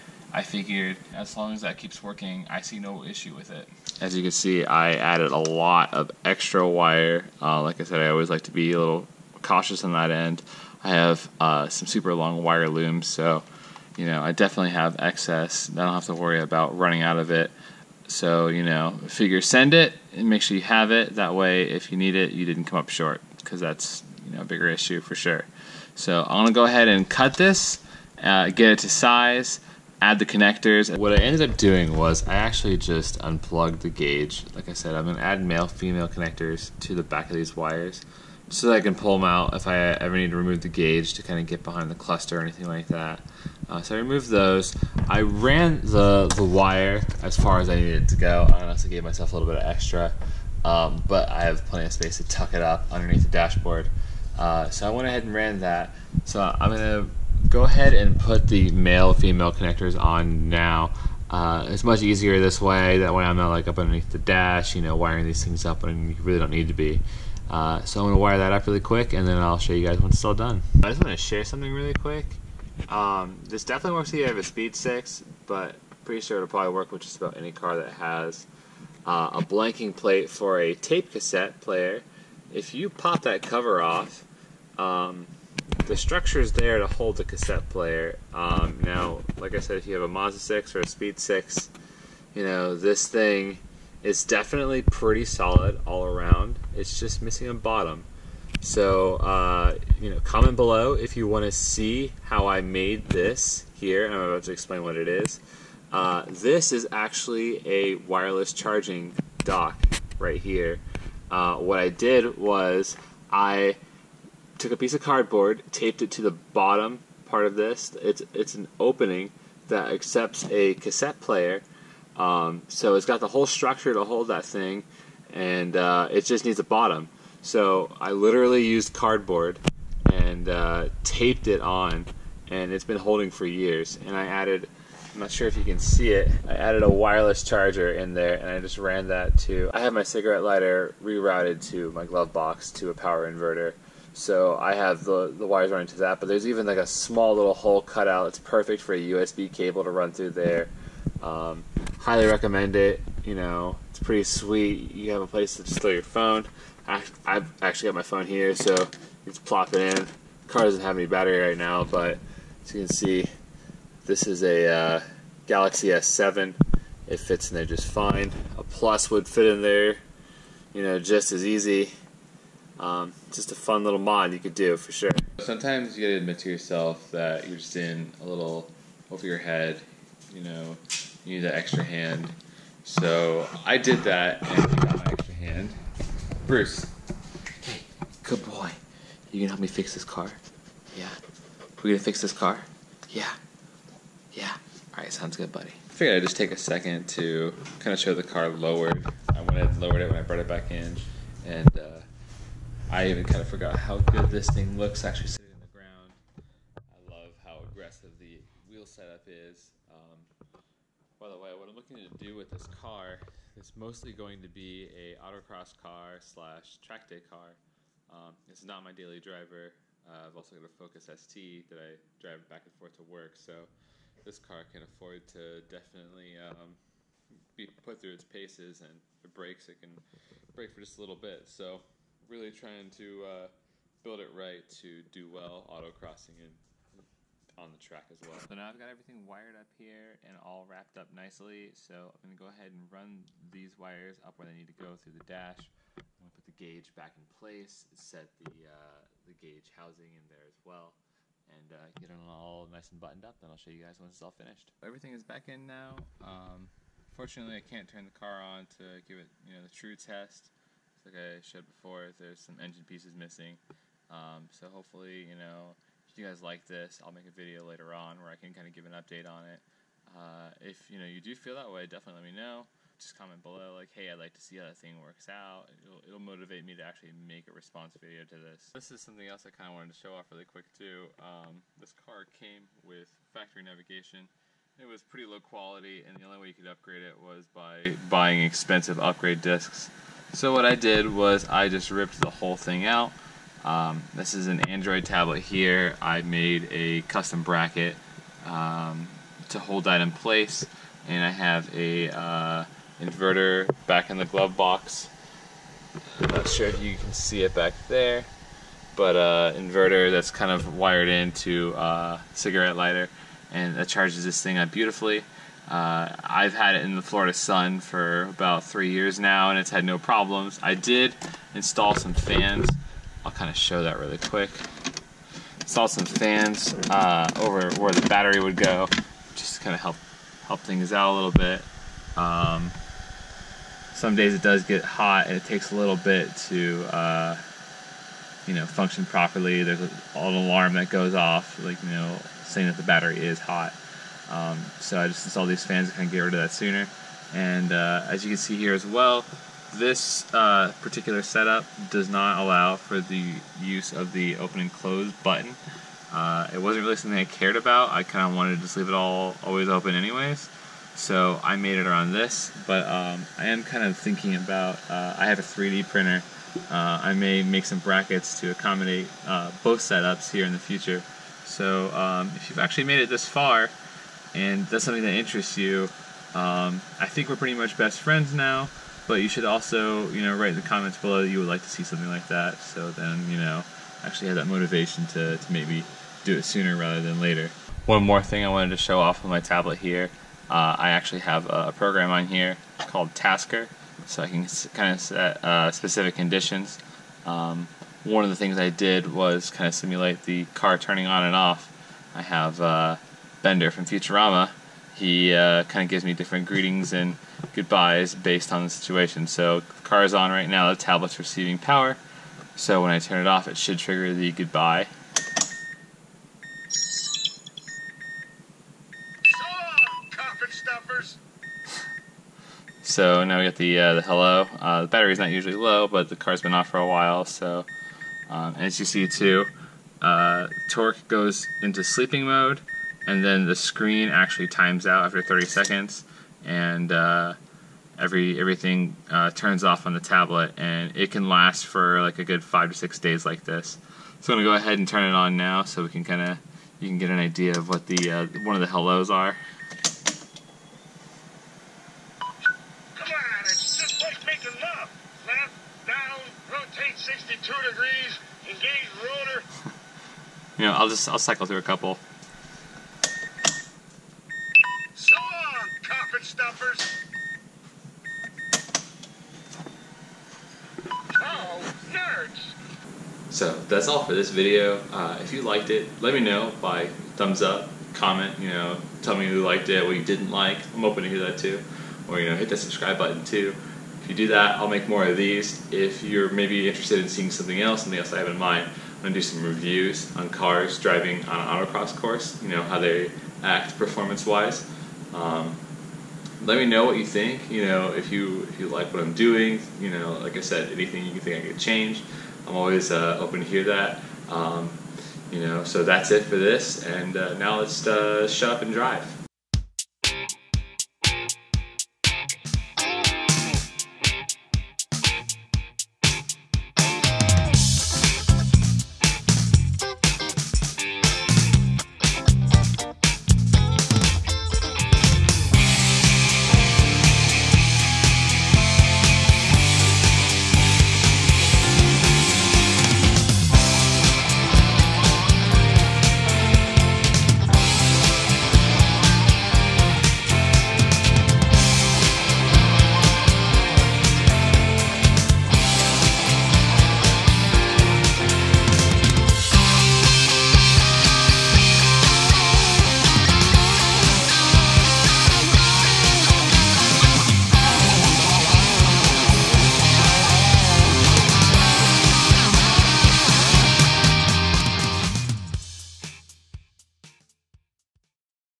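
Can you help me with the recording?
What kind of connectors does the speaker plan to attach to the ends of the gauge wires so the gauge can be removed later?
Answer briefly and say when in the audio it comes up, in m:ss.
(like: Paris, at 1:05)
Male-female connectors, at 0:35.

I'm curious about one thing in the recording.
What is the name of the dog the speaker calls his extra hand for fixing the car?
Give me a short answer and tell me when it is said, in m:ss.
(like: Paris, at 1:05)
Bruce, at 3:06.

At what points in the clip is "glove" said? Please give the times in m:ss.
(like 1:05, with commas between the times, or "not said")
2:22, 5:04.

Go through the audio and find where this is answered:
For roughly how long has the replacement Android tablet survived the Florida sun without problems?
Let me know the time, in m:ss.
5:18.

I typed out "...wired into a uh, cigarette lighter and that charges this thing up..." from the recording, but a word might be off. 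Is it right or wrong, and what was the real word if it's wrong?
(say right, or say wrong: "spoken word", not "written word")
right.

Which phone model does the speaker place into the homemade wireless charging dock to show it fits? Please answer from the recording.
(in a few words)
Galaxy S7.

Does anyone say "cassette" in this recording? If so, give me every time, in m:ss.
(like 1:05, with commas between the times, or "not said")
1:21, 1:27, 2:00.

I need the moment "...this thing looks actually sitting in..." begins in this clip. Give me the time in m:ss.
3:24.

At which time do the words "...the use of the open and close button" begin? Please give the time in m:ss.
5:53.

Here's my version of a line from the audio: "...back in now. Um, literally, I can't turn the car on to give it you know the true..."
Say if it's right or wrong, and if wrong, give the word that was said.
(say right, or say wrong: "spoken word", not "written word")
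wrong: "fortunately", not "literally".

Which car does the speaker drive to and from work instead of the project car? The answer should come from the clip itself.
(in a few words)
Focus ST.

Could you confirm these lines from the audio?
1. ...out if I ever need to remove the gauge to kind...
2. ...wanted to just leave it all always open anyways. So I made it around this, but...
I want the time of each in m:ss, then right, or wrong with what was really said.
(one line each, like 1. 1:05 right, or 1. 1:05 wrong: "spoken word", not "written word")
1. 0:39 right
2. 5:58 right.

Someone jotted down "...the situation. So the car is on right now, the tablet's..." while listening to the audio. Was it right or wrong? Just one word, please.
right.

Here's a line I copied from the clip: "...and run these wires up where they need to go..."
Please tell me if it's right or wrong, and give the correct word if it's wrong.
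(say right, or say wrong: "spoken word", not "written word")
right.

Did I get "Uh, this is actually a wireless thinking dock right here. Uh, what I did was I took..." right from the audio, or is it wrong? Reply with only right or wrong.
wrong.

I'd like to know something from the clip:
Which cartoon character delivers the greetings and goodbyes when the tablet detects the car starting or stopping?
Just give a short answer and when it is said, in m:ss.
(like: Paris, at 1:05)
Bender, at 6:43.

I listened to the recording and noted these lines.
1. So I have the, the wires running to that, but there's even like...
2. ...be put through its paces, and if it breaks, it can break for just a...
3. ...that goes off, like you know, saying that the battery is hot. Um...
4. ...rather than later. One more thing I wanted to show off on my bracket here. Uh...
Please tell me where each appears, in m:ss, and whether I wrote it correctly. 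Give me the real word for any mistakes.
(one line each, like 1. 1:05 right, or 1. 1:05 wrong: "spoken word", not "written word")
1. 2:24 right
2. 3:47 right
3. 5:40 right
4. 6:26 wrong: "tablet", not "bracket".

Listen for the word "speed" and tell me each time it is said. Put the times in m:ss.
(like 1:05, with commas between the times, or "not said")
1:14, 1:30.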